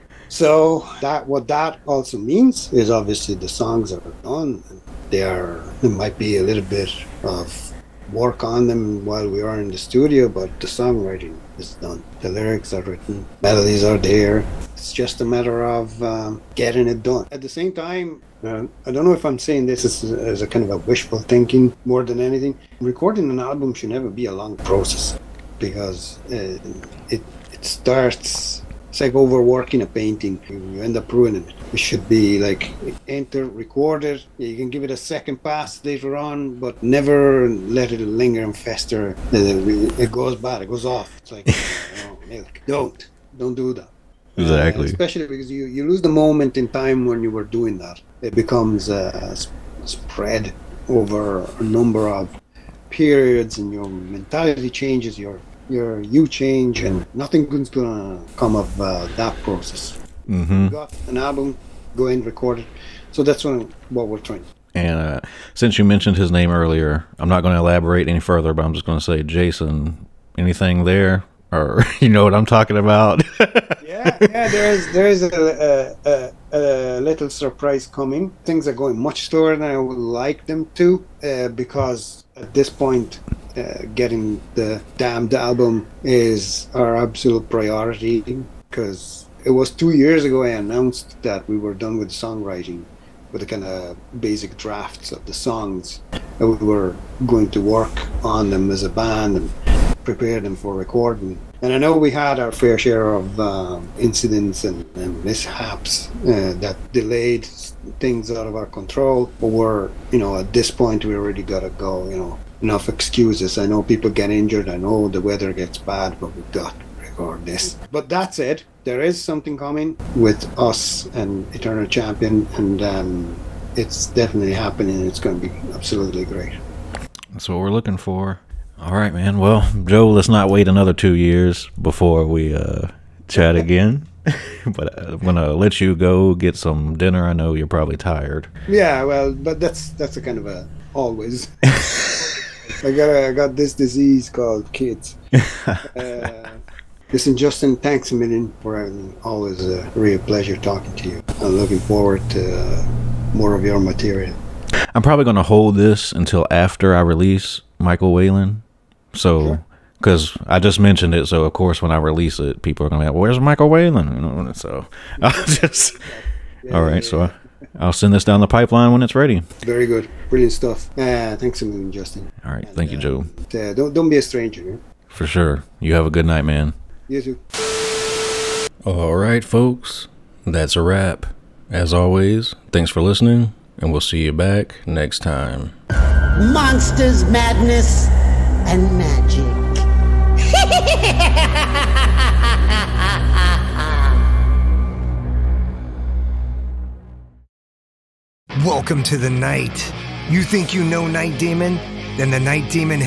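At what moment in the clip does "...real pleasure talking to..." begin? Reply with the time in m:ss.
2:29.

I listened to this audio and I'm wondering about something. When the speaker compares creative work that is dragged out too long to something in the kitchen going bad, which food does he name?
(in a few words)
milk.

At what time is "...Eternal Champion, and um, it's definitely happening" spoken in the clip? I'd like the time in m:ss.
2:01.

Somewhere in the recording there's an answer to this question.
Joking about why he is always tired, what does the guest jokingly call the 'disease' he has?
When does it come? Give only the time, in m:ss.
2:24.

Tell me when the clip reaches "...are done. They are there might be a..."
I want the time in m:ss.
0:03.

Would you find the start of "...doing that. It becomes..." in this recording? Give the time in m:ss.
0:47.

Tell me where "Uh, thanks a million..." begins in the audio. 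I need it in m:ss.
2:50.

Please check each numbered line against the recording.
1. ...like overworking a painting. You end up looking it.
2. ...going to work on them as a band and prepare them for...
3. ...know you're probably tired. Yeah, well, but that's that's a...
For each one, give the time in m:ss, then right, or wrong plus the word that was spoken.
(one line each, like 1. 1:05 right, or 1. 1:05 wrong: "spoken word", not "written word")
1. 0:29 wrong: "ruining", not "looking"
2. 1:37 right
3. 2:17 right.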